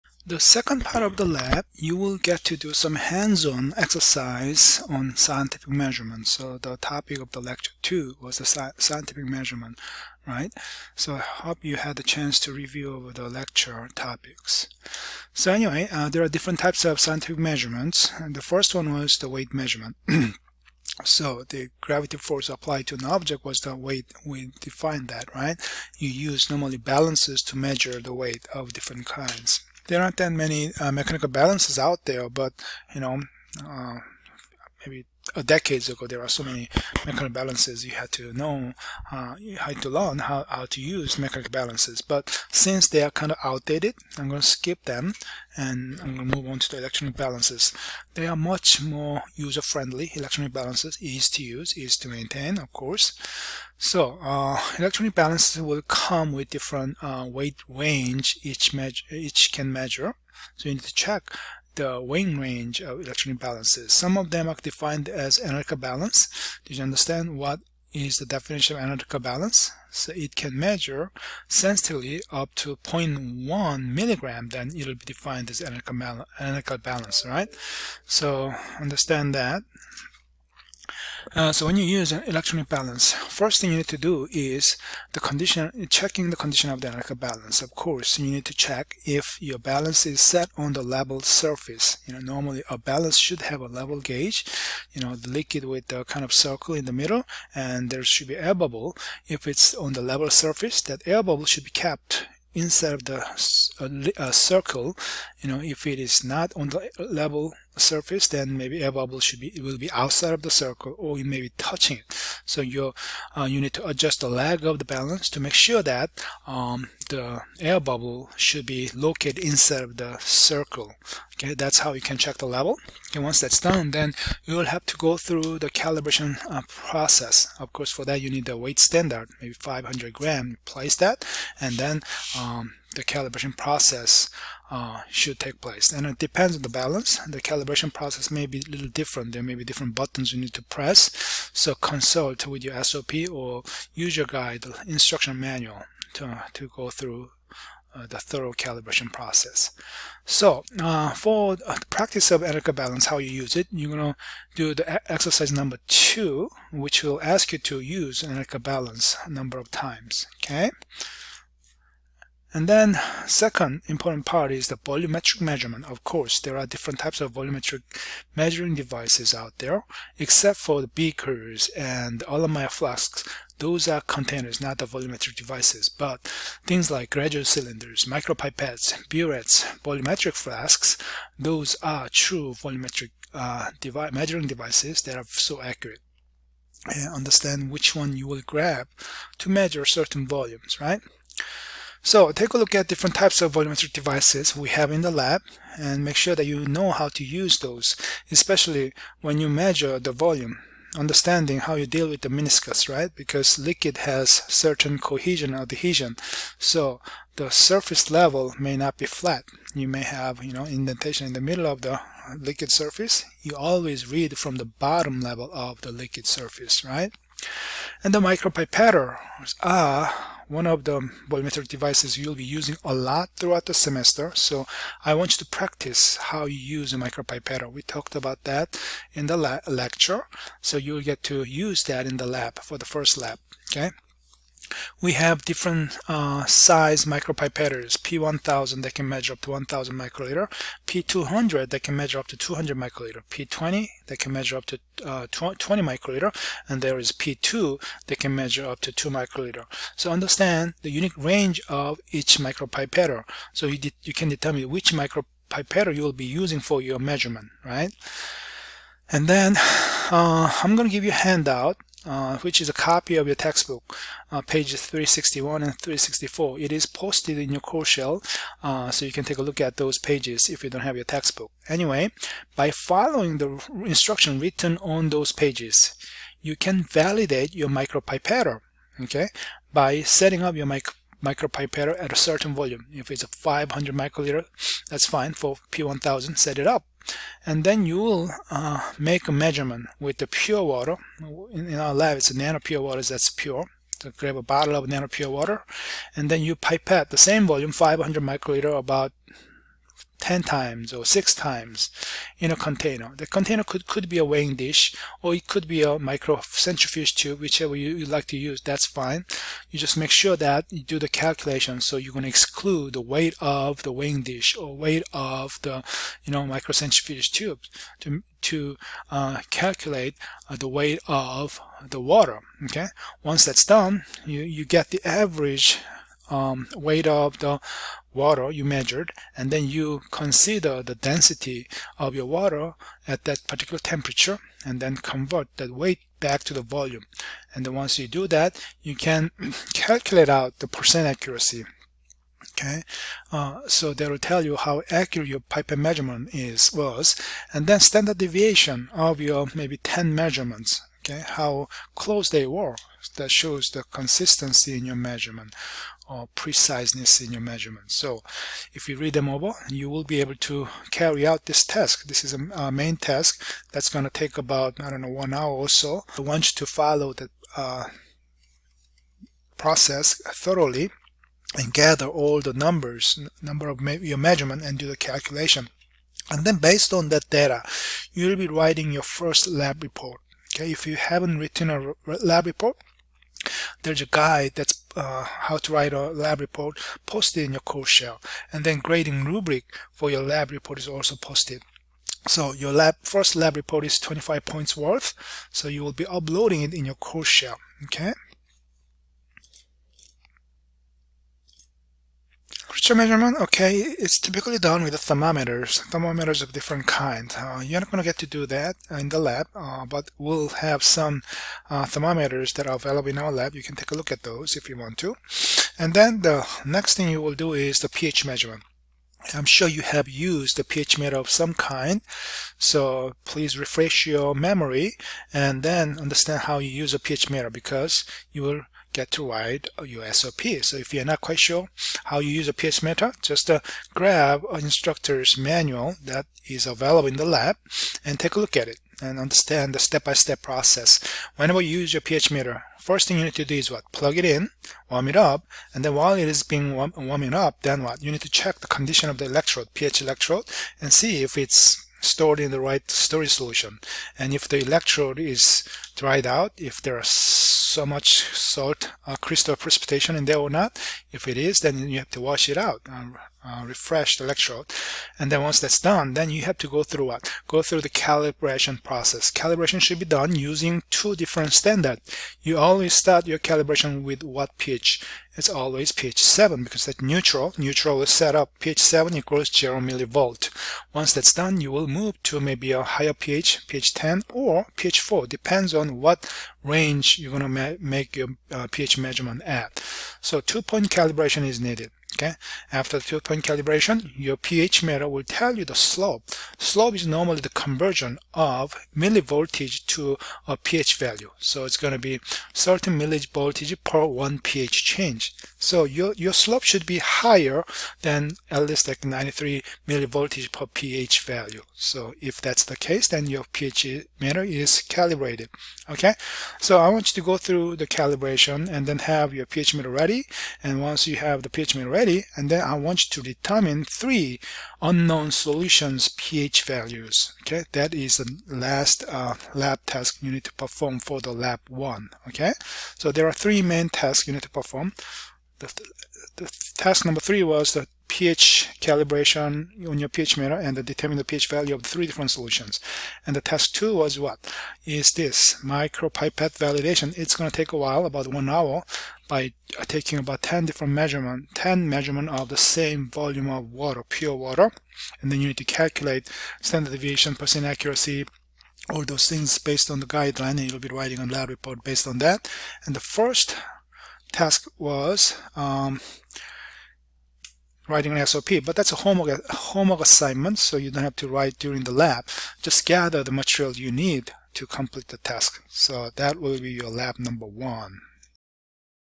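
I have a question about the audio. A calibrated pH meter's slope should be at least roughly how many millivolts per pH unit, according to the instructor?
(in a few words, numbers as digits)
93.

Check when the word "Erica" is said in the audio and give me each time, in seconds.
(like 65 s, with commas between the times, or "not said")
152 s, 158 s.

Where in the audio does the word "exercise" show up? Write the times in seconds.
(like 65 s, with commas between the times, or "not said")
3 s, 155 s.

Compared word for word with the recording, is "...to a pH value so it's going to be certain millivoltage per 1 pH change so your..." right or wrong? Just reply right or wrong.
right.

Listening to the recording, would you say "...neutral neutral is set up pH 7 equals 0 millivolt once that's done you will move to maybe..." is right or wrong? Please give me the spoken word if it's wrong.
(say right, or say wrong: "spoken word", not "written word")
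right.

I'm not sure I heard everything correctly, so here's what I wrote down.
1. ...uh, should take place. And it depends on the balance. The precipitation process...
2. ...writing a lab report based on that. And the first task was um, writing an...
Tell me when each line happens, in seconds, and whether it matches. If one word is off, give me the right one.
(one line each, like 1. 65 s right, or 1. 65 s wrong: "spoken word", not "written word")
1. 134 s wrong: "calibration", not "precipitation"
2. 560 s right.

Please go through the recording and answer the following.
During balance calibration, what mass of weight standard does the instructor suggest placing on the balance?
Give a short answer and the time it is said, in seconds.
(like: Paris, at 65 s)
500 gram, at 129 s.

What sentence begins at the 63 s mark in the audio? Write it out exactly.
Some of them are defined as analytical balance.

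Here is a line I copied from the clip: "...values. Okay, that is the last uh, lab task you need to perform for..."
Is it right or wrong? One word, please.
right.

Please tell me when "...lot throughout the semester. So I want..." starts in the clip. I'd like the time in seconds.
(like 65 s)
222 s.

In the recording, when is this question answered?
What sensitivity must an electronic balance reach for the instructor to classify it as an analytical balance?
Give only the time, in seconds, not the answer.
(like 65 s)
72 s.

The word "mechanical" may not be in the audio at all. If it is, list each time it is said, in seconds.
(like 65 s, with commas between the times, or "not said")
30 s, 37 s, 41 s.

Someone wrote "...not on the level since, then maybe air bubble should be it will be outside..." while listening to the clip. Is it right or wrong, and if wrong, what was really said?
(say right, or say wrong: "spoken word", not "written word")
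wrong: "surface", not "since".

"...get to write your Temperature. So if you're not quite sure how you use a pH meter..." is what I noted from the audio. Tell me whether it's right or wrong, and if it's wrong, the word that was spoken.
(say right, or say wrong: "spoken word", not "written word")
wrong: "SOP", not "Temperature".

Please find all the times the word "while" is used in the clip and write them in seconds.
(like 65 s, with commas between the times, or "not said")
445 s, 547 s.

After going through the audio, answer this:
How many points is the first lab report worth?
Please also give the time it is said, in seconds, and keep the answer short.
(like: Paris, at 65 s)
25, at 393 s.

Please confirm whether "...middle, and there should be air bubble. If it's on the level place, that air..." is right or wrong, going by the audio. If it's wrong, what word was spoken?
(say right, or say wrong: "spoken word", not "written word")
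wrong: "surface", not "place".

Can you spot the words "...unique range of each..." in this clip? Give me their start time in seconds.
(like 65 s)
250 s.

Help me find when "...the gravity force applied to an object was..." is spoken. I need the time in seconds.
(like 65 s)
21 s.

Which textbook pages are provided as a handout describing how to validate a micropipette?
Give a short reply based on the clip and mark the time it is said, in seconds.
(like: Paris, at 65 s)
361 and 364, at 264 s.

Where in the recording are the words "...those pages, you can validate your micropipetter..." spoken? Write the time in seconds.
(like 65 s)
275 s.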